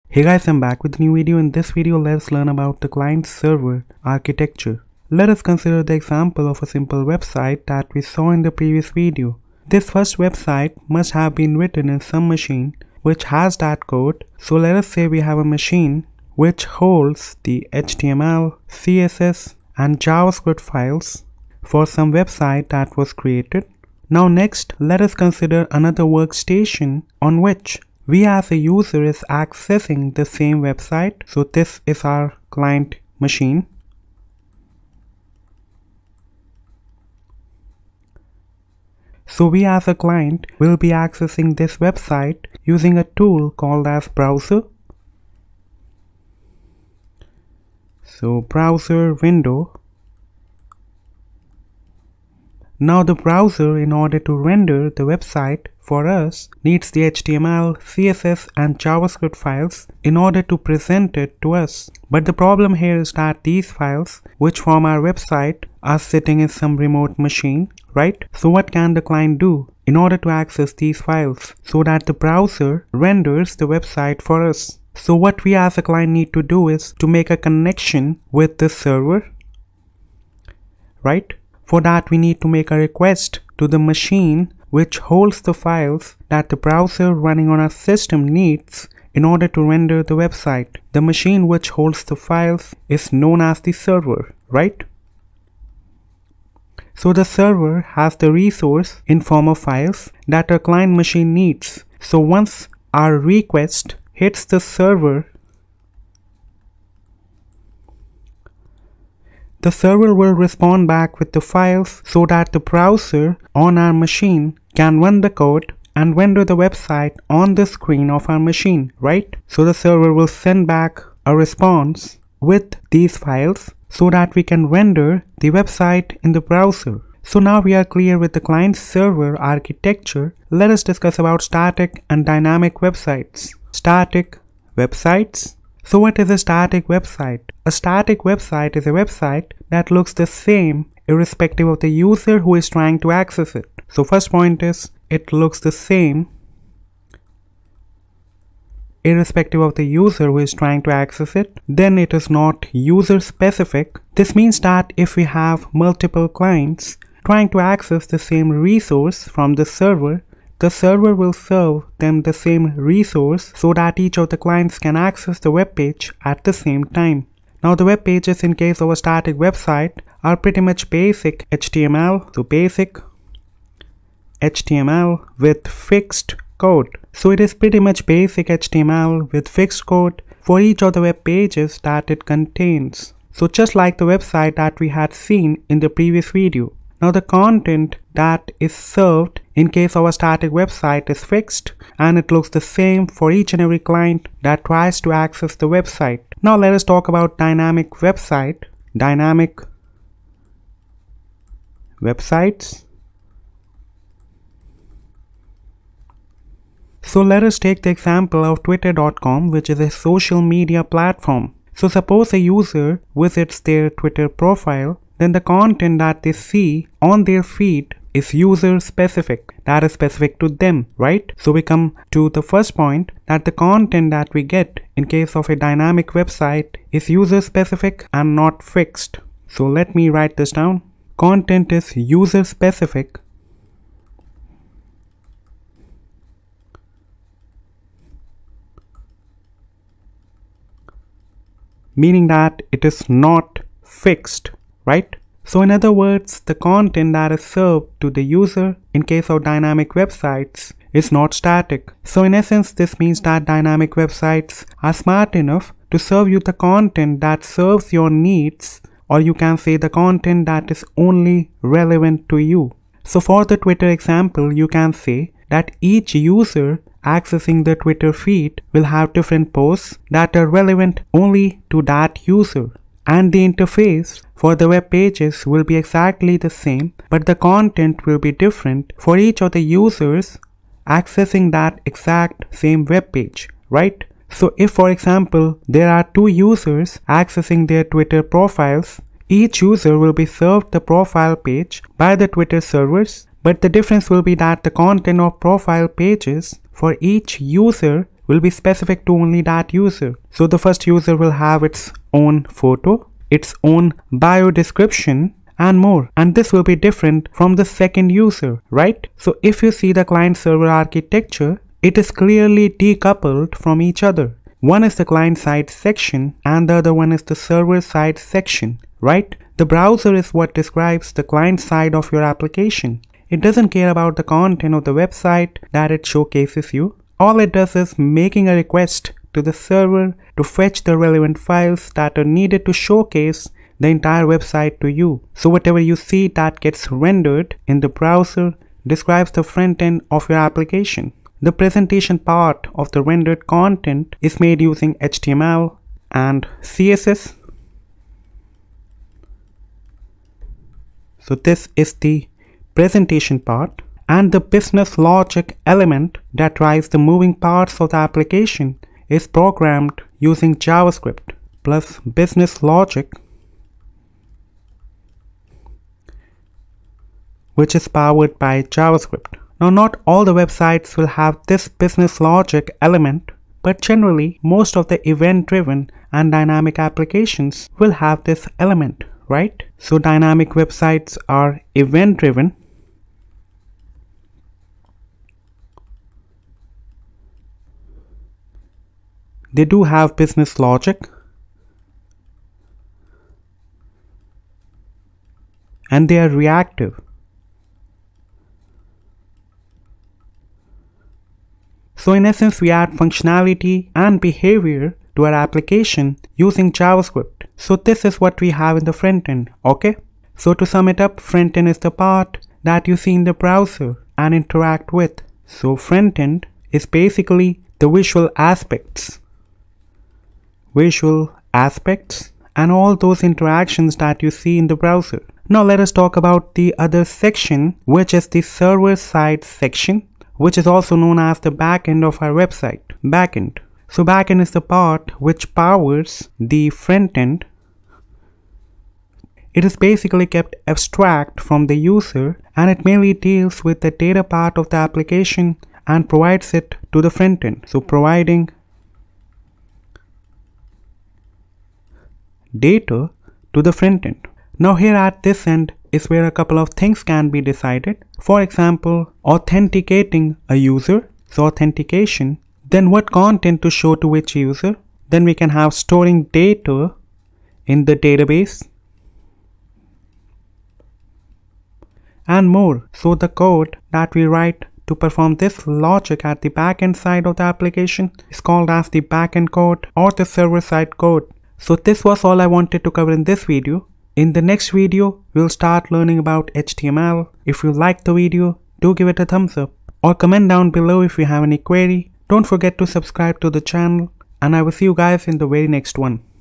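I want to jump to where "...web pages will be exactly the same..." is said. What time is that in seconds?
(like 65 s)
274 s.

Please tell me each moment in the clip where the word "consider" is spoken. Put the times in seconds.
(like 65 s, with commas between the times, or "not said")
5 s, 25 s.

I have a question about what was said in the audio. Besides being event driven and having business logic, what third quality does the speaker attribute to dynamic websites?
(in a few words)
Reactive.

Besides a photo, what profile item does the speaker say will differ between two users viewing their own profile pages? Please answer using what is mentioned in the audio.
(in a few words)
Bio description.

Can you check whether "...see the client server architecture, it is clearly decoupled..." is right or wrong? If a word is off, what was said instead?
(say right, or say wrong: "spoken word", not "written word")
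right.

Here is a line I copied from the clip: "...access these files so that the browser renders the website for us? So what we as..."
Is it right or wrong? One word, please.
right.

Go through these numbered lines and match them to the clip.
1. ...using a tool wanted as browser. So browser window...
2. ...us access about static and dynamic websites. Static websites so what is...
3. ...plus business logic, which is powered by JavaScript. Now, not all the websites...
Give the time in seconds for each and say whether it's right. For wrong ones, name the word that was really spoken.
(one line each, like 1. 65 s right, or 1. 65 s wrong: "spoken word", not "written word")
1. 42 s wrong: "called", not "wanted"
2. 130 s wrong: "discuss", not "access"
3. 361 s right.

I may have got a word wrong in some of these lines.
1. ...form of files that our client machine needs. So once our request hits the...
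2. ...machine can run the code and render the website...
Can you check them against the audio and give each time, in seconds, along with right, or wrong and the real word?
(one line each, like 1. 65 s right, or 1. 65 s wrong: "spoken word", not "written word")
1. 99 s right
2. 113 s right.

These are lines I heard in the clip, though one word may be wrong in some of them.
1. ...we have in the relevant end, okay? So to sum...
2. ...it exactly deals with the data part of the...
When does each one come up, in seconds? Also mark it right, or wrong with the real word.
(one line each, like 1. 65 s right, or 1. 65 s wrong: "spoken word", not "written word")
1. 408 s wrong: "front", not "relevant"
2. 442 s wrong: "mainly", not "exactly".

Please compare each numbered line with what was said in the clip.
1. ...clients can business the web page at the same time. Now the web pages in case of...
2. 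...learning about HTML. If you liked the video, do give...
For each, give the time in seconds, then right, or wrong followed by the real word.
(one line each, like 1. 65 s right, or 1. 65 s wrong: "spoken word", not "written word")
1. 164 s wrong: "access", not "business"
2. 485 s right.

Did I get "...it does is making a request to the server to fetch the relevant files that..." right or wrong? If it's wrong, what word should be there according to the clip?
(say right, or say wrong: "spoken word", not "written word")
right.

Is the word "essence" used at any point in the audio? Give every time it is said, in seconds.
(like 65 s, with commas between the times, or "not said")
252 s, 402 s.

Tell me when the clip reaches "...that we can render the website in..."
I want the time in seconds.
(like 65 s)
124 s.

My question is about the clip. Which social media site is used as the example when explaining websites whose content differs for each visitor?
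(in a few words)
twitter.com.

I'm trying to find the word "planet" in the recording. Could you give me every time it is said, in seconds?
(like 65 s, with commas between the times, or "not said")
not said.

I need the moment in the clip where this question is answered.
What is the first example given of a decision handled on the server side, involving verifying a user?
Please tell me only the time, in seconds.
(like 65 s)
461 s.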